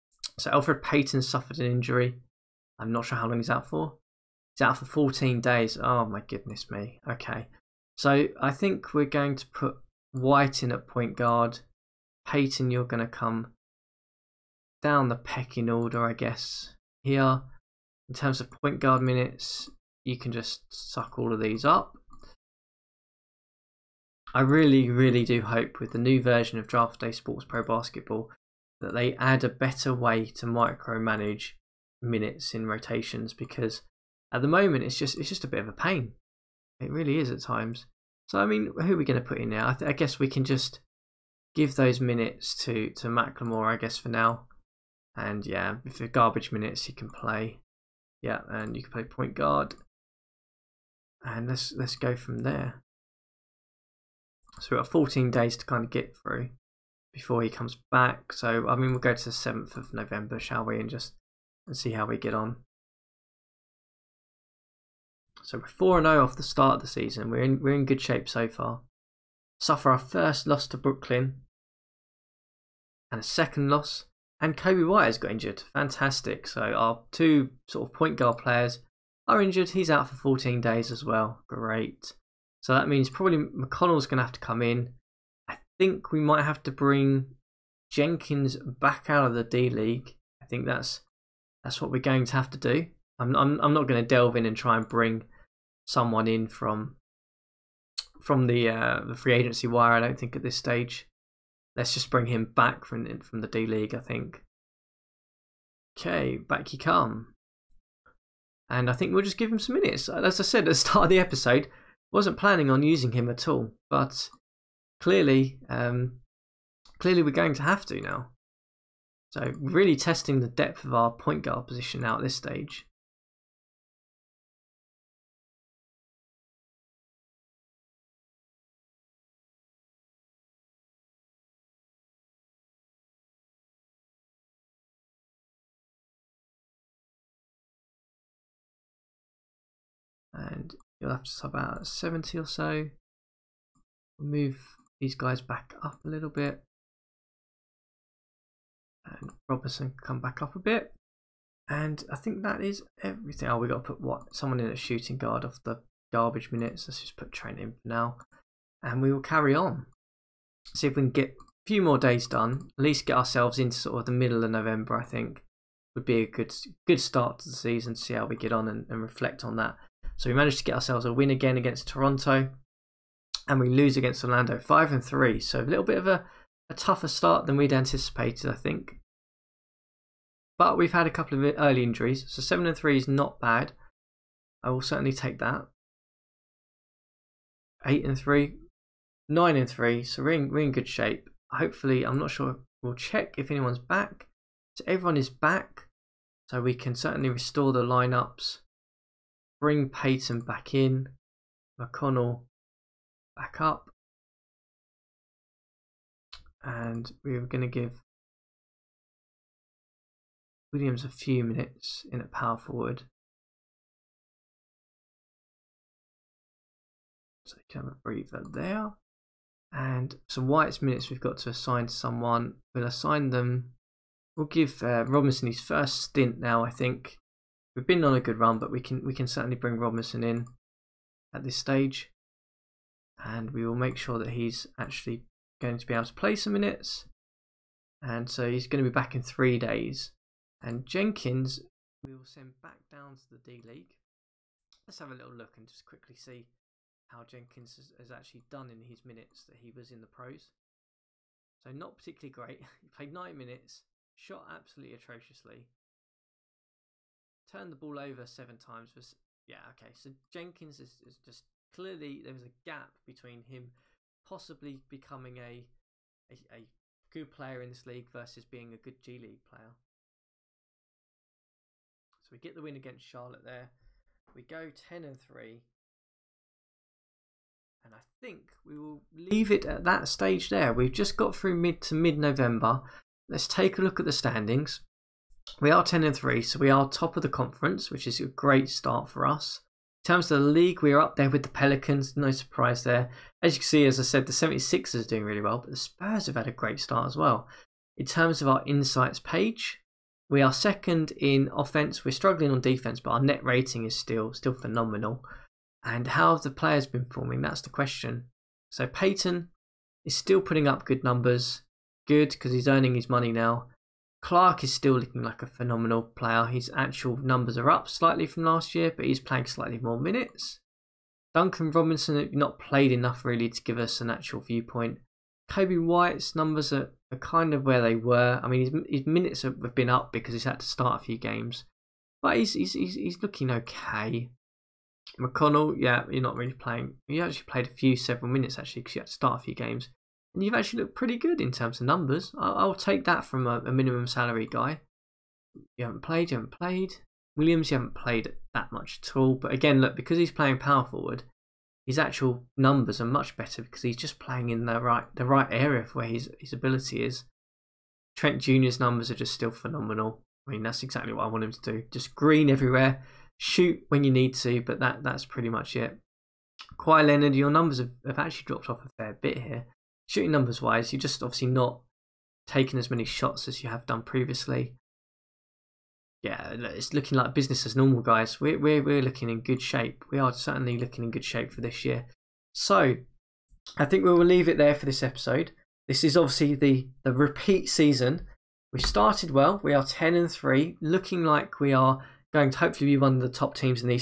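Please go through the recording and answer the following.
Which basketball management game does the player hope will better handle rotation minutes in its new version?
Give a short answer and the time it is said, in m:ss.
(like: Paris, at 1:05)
Draft Day Sports Pro Basketball, at 0:26.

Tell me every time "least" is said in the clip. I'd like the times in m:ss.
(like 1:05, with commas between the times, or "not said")
2:42.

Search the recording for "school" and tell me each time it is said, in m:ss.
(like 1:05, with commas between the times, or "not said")
not said.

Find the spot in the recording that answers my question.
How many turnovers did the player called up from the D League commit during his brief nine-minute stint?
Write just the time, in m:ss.
4:18.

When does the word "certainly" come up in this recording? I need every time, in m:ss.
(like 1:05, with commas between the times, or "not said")
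3:04, 3:16, 3:49, 6:20.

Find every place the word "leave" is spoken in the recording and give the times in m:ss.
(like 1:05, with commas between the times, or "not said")
4:39, 6:24.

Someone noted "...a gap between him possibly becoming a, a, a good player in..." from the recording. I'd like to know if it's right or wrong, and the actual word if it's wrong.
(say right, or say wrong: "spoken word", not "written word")
right.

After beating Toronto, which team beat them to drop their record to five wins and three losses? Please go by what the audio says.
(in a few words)
Orlando.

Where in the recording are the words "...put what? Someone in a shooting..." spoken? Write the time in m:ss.
2:33.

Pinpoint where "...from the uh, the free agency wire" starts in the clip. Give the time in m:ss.
1:38.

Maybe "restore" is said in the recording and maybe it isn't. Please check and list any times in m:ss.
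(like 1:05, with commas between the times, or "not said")
3:17.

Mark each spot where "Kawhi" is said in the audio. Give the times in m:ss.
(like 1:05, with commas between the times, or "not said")
6:06.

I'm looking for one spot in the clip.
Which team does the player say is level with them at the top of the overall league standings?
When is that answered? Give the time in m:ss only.
4:51.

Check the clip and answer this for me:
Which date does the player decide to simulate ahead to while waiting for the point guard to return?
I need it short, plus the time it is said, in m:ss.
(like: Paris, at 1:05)
7th of November, at 0:59.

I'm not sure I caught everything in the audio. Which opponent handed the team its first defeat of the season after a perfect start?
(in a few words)
Brooklyn.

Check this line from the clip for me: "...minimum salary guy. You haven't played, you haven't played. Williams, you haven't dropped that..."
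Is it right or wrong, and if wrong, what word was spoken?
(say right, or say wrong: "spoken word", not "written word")
wrong: "played", not "dropped".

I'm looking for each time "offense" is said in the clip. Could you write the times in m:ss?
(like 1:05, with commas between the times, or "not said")
5:01.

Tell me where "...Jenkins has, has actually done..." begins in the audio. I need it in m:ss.
4:07.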